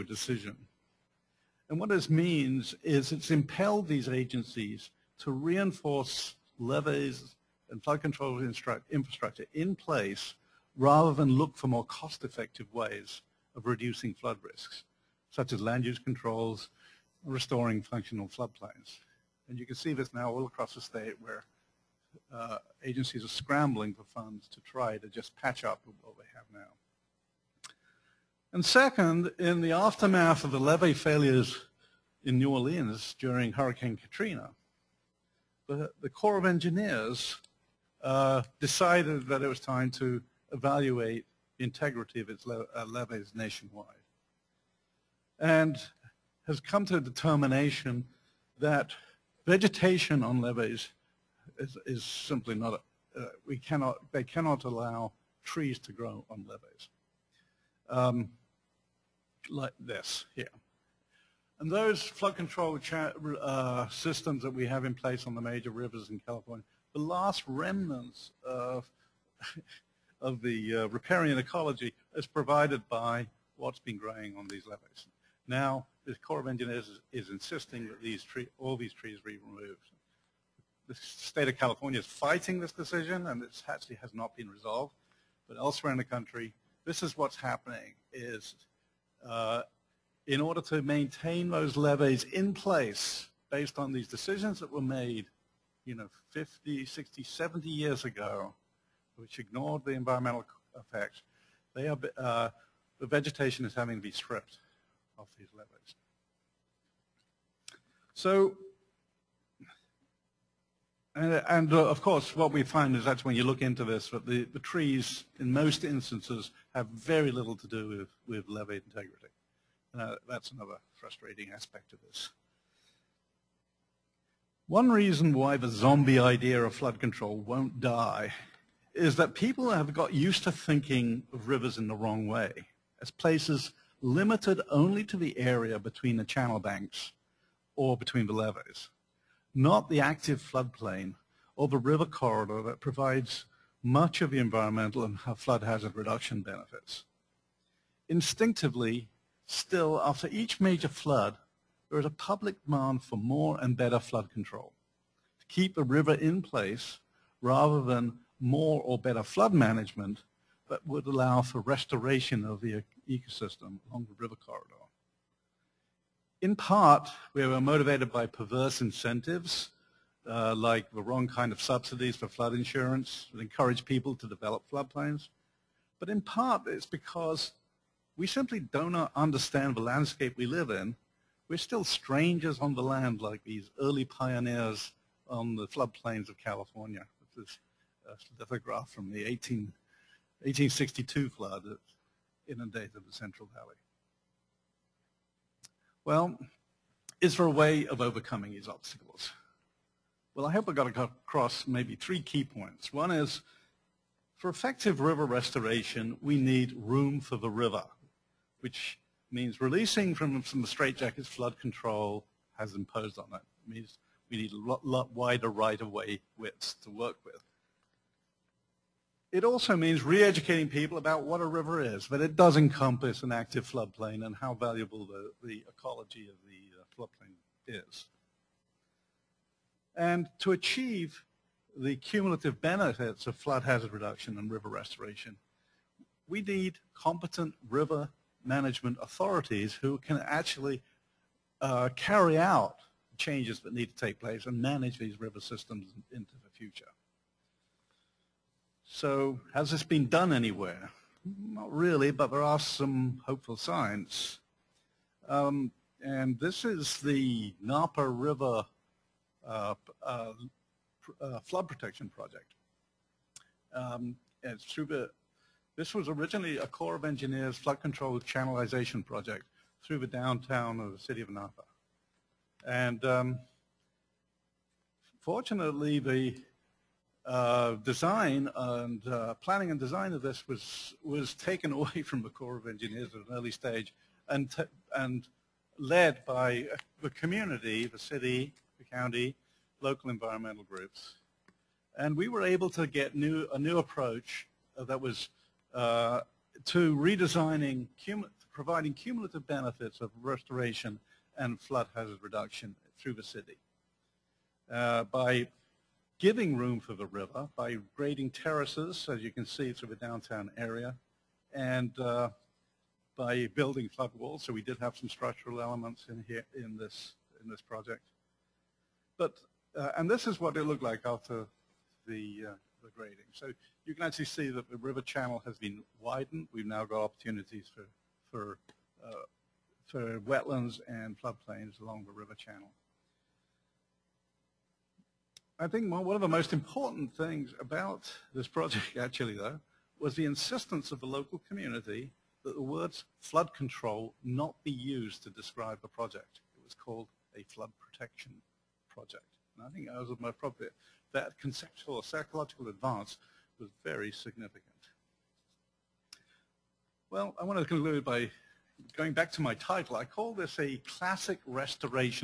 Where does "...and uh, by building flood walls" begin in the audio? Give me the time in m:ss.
5:11.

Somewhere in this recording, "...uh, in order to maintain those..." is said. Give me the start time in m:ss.
1:29.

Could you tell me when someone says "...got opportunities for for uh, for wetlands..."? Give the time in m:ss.
5:26.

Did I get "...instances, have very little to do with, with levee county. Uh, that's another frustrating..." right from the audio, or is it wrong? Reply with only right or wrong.
wrong.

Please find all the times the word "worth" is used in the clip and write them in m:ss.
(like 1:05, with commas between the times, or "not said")
not said.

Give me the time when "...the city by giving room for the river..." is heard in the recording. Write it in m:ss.
5:03.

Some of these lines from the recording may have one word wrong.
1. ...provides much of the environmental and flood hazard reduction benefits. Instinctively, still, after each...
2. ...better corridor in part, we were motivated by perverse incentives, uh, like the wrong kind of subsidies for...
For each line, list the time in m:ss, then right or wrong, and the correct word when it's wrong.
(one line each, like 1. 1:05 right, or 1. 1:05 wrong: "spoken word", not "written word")
1. 2:22 right
2. 2:44 wrong: "river", not "better".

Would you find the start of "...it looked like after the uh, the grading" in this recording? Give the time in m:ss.
5:20.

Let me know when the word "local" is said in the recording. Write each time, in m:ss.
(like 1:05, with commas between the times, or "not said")
4:49, 5:41.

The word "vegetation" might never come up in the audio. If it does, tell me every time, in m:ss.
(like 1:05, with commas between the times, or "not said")
0:49, 1:43.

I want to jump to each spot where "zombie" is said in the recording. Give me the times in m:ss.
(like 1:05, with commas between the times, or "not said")
2:05.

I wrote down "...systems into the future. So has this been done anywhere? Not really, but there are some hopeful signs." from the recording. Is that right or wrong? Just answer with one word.
right.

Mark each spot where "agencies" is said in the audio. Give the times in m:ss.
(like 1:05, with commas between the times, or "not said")
0:04, 0:22.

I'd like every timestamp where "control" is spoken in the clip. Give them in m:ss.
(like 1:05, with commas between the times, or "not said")
0:07, 0:15, 1:02, 2:06, 2:34, 3:31, 4:27, 5:43.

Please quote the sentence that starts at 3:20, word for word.
Well, I hope I got across maybe three key points.